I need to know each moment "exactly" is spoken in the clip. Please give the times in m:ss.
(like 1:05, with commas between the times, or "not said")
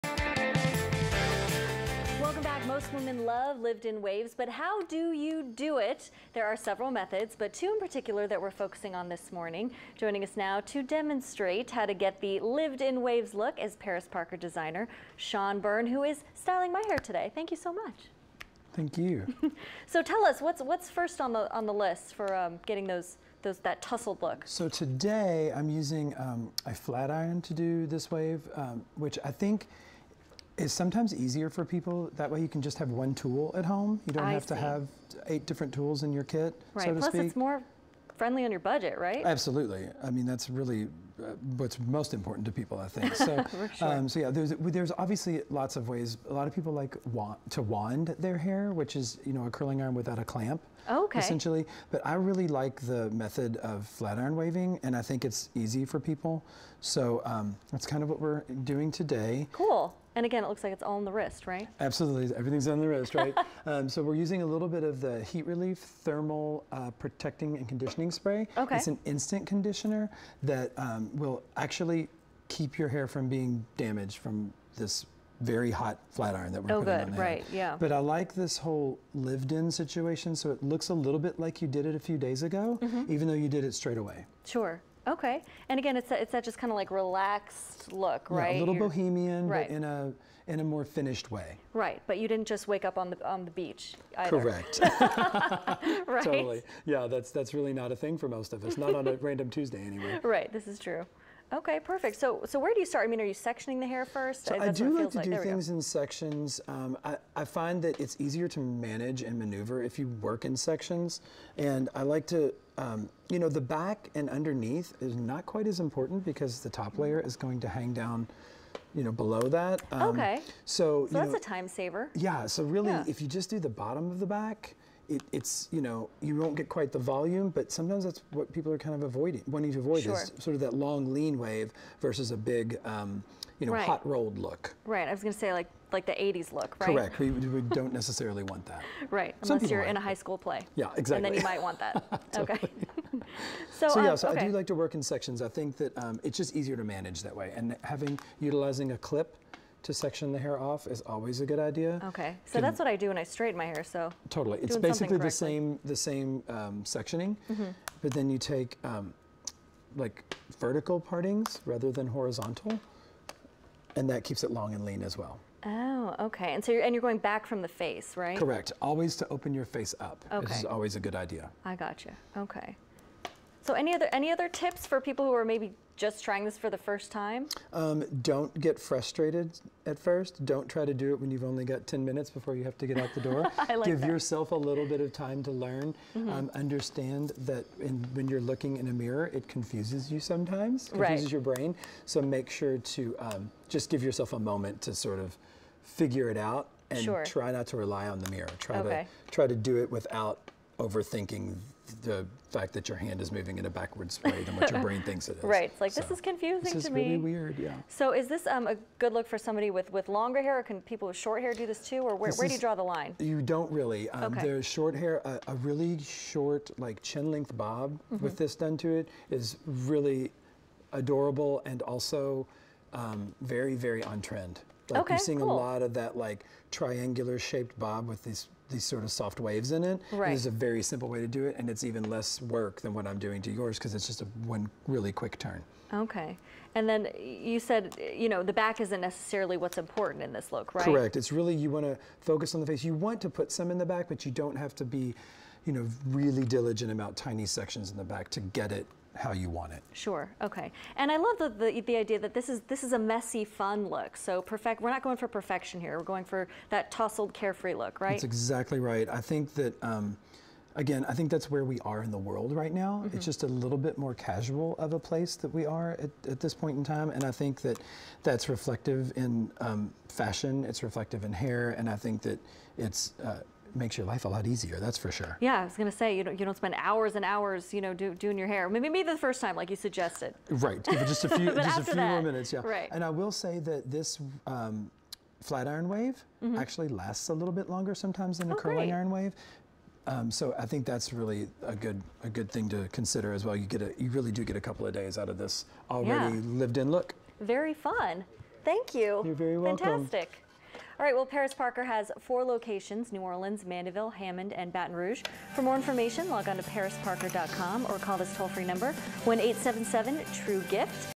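2:20, 4:18.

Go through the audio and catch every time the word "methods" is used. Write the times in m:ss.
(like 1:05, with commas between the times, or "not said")
0:06, 0:53.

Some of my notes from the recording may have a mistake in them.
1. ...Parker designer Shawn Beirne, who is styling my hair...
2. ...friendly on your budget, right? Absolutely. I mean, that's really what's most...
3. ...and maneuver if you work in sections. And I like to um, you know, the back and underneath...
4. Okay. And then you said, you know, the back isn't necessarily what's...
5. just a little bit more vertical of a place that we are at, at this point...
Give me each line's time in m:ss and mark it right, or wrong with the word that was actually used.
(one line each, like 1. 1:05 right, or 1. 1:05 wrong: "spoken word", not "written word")
1. 0:14 right
2. 0:38 right
3. 1:49 right
4. 3:55 right
5. 4:23 wrong: "casual", not "vertical".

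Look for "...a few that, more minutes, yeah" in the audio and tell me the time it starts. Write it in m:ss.
4:41.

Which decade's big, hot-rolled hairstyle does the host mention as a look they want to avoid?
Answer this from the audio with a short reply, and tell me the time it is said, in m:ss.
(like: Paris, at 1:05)
the 80s, at 2:16.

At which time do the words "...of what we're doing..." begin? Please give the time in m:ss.
0:58.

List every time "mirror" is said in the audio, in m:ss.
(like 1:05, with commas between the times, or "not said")
3:08, 3:18.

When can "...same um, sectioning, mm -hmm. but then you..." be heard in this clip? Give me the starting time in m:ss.
2:35.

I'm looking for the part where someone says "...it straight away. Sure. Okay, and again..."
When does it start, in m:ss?
1:23.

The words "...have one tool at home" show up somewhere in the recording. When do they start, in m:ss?
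0:32.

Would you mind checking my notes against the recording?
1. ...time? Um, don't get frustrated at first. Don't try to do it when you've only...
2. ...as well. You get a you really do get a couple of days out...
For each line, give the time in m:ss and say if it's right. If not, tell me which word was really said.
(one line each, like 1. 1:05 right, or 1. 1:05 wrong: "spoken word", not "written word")
1. 2:57 right
2. 4:53 right.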